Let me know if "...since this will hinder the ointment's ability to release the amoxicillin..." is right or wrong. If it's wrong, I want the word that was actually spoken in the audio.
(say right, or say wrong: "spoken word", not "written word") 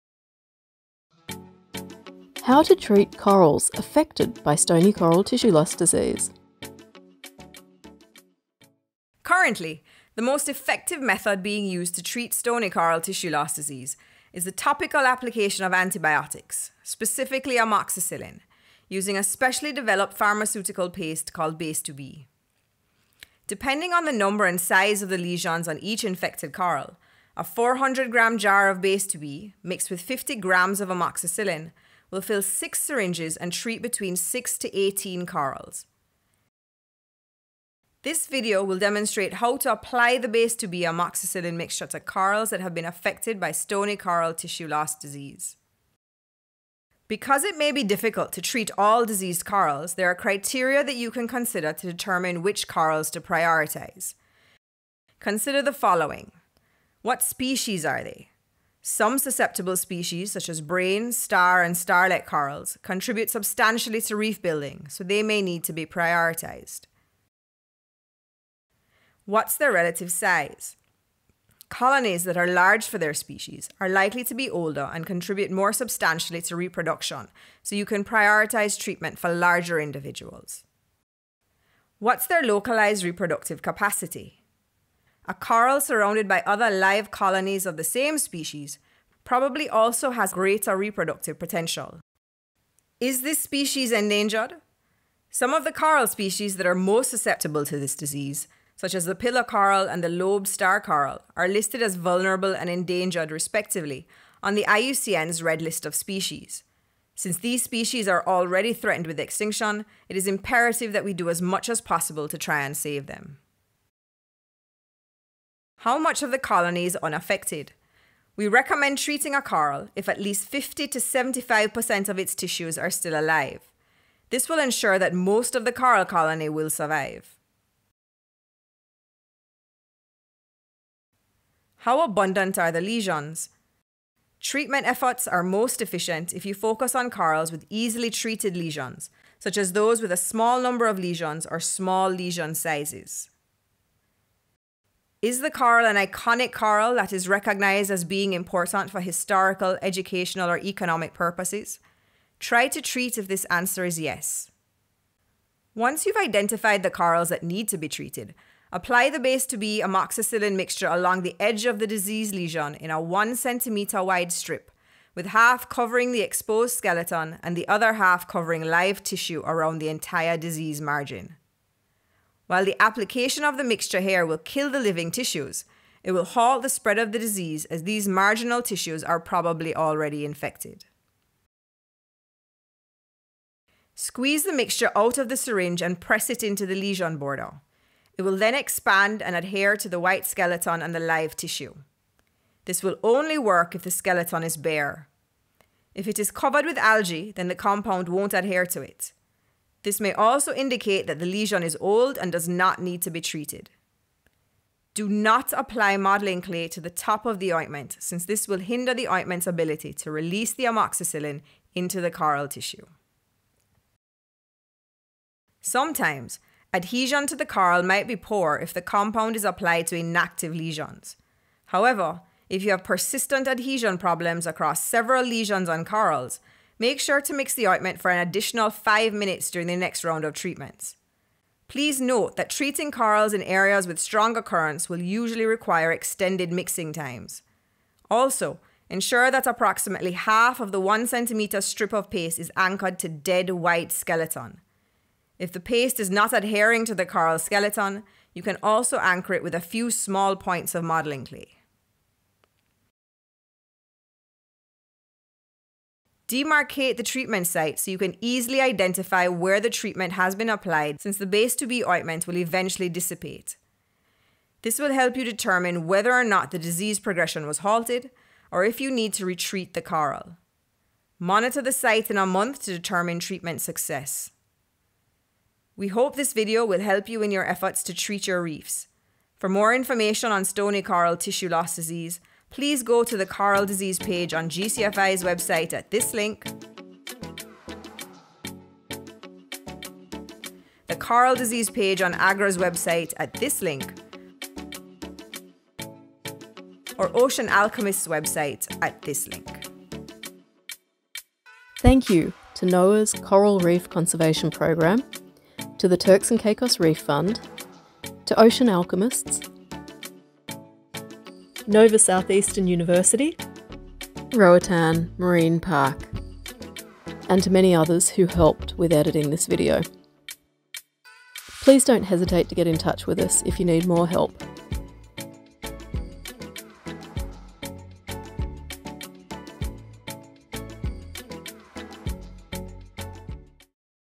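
right.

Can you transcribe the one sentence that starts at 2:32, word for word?
Try to treat if this answer is yes.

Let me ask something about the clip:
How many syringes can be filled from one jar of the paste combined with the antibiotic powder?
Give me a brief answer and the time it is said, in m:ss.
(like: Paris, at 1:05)
6, at 0:32.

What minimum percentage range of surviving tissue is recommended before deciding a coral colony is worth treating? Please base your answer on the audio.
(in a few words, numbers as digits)
50 to 75%.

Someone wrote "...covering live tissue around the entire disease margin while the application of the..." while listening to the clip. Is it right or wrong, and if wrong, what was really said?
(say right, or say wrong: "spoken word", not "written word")
right.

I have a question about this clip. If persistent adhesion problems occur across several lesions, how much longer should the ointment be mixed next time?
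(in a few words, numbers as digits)
5 minutes.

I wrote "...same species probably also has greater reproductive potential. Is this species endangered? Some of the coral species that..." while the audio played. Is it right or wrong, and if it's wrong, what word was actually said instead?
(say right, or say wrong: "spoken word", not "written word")
right.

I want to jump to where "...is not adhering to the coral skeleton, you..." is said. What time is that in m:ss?
4:05.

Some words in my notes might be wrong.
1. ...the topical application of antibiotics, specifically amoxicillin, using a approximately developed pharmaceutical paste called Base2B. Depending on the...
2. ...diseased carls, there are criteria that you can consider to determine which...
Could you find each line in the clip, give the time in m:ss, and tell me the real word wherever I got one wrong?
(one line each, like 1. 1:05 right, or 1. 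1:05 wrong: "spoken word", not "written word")
1. 0:14 wrong: "specially", not "approximately"
2. 0:49 wrong: "corals", not "carls".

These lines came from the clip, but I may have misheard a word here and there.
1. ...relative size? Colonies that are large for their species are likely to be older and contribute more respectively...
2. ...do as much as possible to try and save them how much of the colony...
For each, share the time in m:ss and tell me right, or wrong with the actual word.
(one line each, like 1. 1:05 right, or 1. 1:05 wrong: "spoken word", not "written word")
1. 1:09 wrong: "substantially", not "respectively"
2. 1:51 right.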